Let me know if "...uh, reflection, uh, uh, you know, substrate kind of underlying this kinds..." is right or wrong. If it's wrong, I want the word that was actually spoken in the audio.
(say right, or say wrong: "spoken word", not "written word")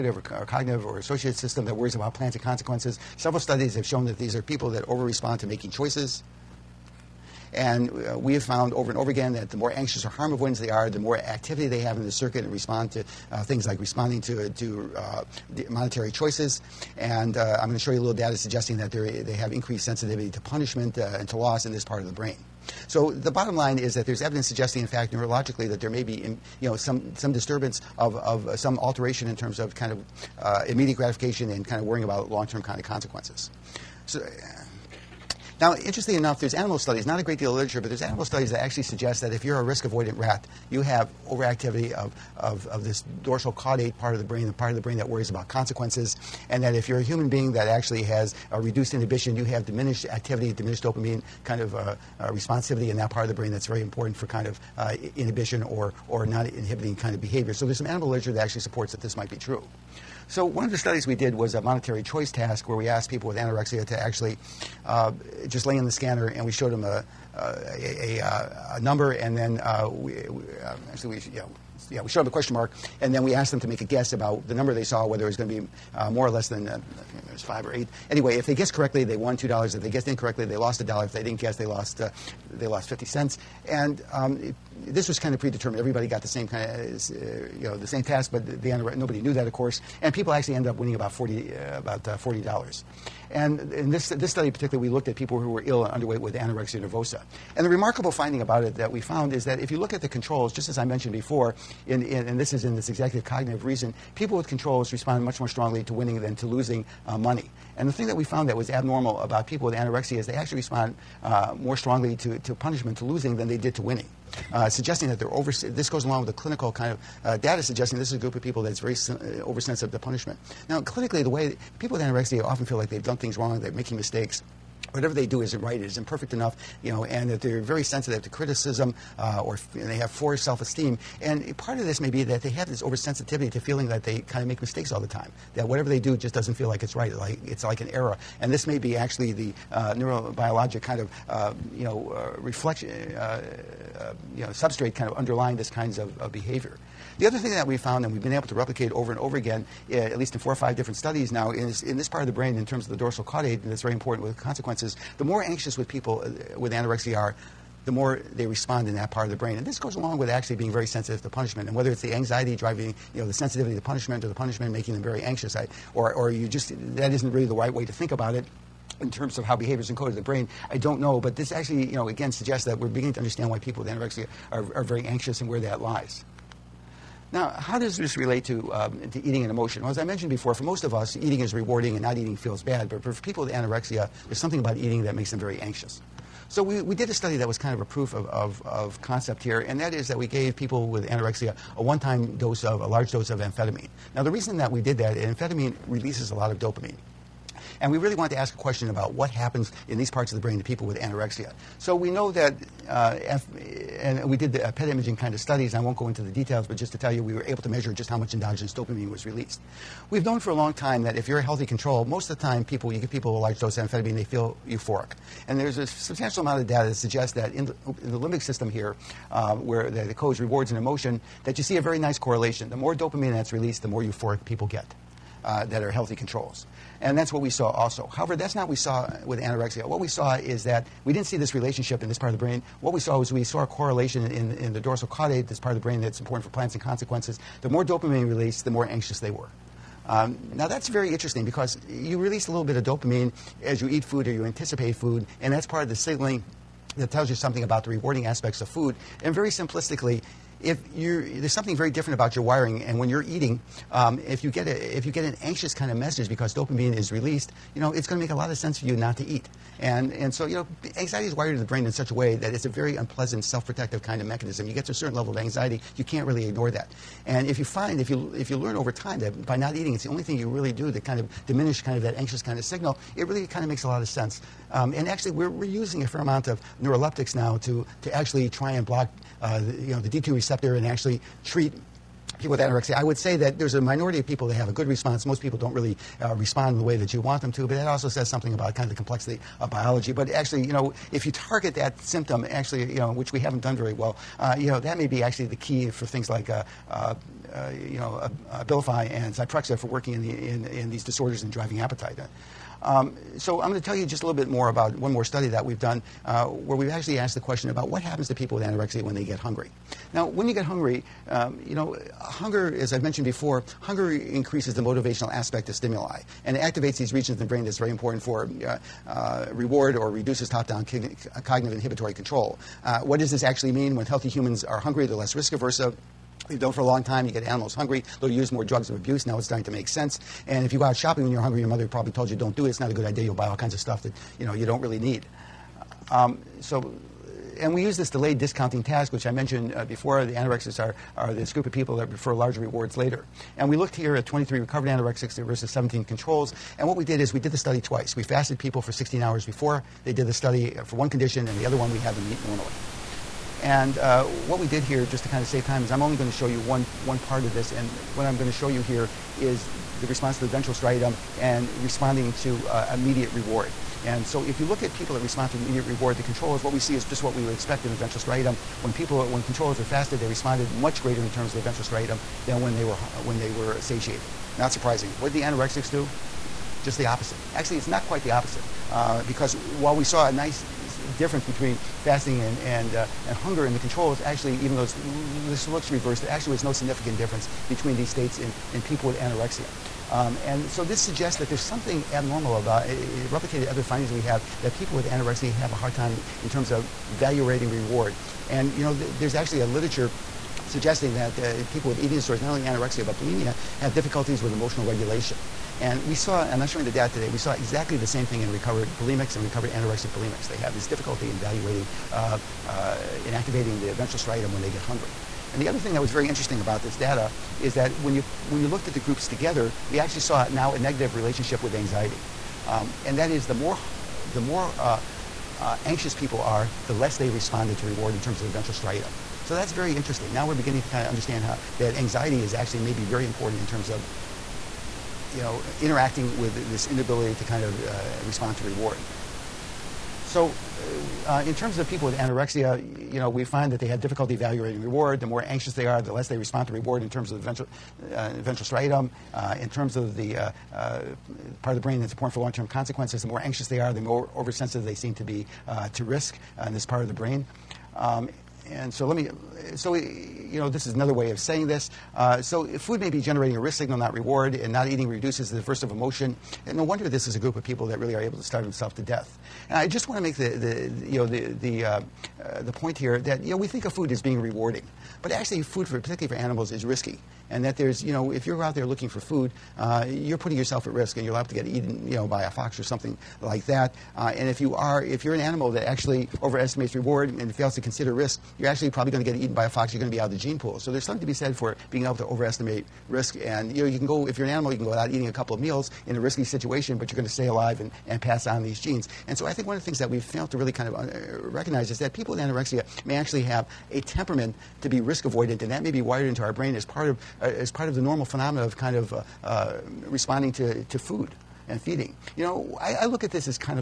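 right.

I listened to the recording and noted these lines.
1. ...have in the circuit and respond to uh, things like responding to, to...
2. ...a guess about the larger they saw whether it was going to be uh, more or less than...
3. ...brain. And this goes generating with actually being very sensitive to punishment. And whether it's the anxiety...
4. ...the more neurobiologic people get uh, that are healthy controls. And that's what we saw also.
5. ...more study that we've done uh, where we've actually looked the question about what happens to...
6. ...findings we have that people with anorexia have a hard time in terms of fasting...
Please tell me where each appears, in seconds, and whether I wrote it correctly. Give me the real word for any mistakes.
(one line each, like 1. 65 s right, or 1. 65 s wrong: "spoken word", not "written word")
1. 11 s right
2. 73 s wrong: "number", not "larger"
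3. 159 s wrong: "along", not "generating"
4. 223 s wrong: "euphoric", not "neurobiologic"
5. 305 s wrong: "asked", not "looked"
6. 393 s wrong: "valuating", not "fasting".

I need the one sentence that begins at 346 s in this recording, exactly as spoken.
And what we did is we did the study twice.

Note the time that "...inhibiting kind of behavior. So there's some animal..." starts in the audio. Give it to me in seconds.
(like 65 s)
56 s.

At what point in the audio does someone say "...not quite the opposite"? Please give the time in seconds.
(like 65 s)
377 s.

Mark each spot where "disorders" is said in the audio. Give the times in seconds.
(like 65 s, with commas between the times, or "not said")
301 s, 402 s.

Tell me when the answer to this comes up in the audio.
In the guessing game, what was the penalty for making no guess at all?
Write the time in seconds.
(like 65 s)
82 s.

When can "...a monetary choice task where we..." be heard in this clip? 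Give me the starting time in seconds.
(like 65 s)
61 s.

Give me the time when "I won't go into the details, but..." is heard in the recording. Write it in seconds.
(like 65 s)
205 s.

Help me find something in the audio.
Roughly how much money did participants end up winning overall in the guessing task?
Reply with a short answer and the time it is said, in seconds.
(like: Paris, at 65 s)
$40, at 92 s.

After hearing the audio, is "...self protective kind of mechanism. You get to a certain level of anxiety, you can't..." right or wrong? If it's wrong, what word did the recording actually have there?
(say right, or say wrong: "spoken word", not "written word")
right.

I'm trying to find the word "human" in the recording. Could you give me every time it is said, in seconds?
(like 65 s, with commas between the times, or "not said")
47 s, 324 s.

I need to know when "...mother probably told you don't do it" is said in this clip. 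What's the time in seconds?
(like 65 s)
331 s.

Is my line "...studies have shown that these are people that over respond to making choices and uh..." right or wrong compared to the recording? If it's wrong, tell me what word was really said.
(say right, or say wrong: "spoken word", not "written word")
right.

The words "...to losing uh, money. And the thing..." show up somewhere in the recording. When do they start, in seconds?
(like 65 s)
106 s.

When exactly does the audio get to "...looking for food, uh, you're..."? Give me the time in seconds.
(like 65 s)
478 s.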